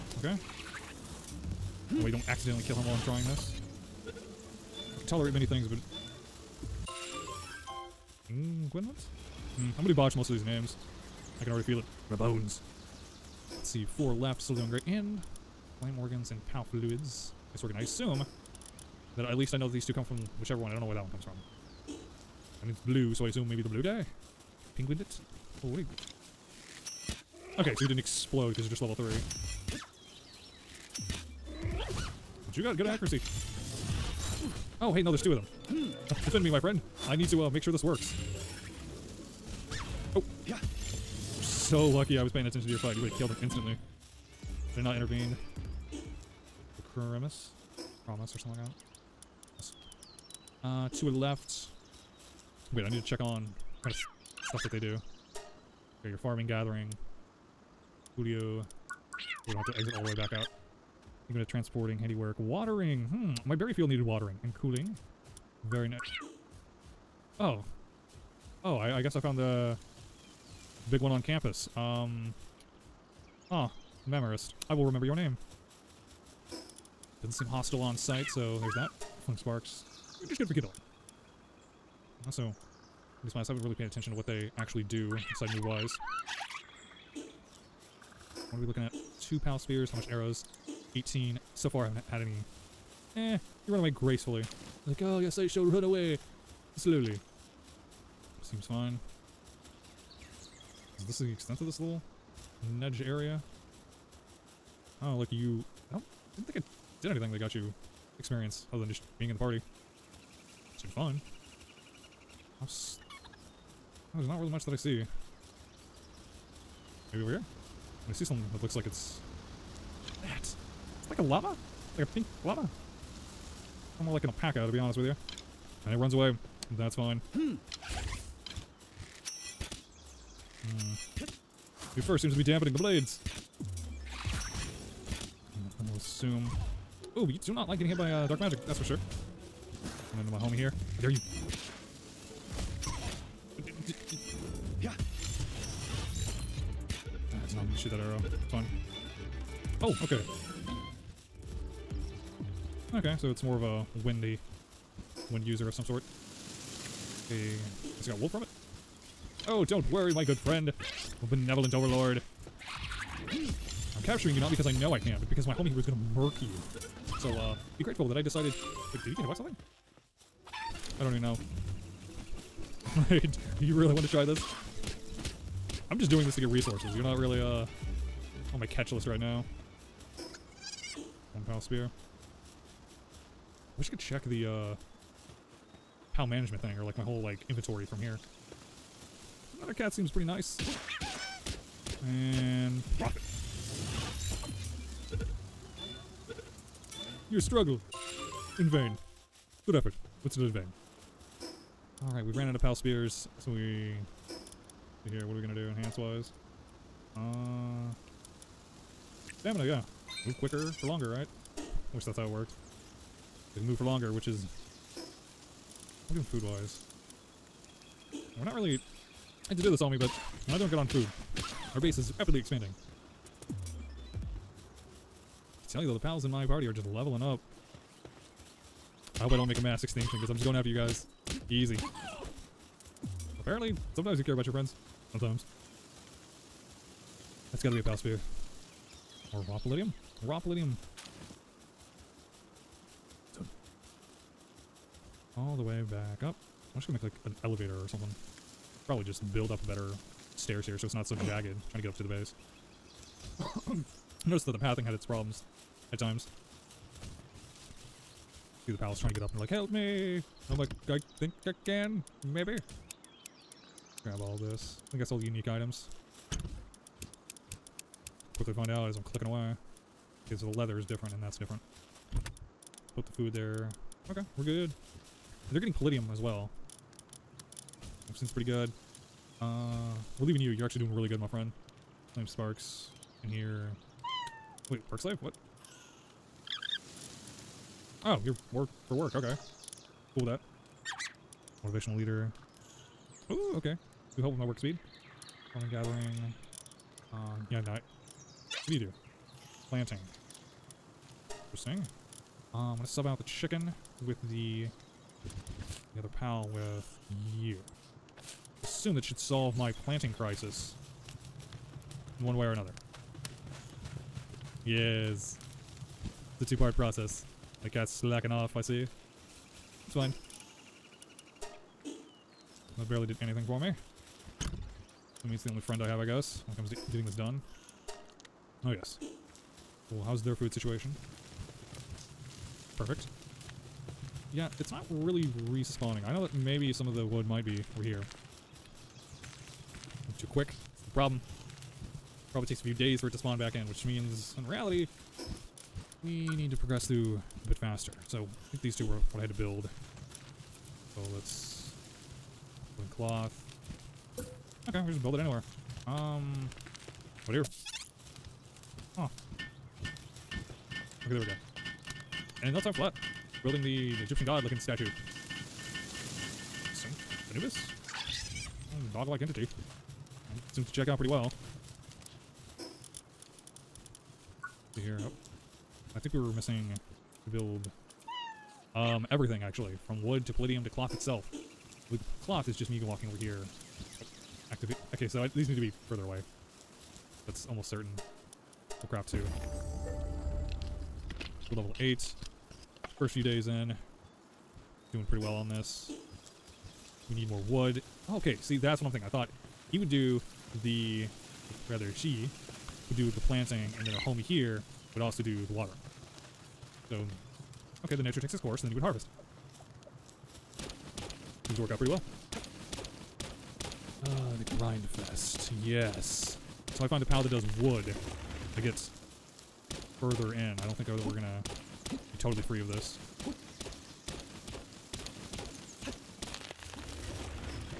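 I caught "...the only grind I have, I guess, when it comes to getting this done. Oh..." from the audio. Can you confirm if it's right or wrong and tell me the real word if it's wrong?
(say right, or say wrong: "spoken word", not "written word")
wrong: "friend", not "grind".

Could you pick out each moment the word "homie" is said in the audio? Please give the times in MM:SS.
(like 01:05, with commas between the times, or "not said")
02:20, 02:45, 06:43.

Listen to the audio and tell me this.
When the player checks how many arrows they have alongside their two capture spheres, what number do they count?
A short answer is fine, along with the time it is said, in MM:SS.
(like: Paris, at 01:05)
18, at 01:30.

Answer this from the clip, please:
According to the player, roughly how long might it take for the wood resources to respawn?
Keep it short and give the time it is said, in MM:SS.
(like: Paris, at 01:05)
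a few days, at 05:42.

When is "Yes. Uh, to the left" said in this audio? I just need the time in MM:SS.
00:49.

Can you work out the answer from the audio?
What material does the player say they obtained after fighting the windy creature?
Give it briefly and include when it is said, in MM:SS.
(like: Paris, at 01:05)
wool, at 02:38.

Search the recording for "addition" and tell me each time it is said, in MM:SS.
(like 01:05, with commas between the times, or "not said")
not said.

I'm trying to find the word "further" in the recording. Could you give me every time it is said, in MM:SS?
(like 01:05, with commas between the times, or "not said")
06:25, 07:00.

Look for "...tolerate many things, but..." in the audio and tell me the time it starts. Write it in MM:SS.
00:05.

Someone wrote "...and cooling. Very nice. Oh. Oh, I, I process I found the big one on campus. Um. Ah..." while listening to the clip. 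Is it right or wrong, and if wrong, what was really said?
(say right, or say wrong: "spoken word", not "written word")
wrong: "guess", not "process".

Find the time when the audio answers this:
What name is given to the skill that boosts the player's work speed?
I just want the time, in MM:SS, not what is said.
04:51.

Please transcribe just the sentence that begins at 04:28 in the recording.
Quickly find out as I'm clicking away.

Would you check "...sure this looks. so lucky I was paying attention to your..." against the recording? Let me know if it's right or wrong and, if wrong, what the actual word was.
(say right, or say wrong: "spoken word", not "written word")
wrong: "works", not "looks".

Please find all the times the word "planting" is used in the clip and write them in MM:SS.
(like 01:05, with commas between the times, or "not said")
04:59, 05:09, 06:43.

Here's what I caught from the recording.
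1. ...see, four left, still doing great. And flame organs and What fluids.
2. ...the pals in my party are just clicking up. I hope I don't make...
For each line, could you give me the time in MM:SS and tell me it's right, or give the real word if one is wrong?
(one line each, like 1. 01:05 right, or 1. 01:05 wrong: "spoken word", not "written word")
1. 00:13 wrong: "Pal", not "What"
2. 03:45 wrong: "leveling", not "clicking".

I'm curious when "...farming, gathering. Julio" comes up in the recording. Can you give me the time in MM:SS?
00:56.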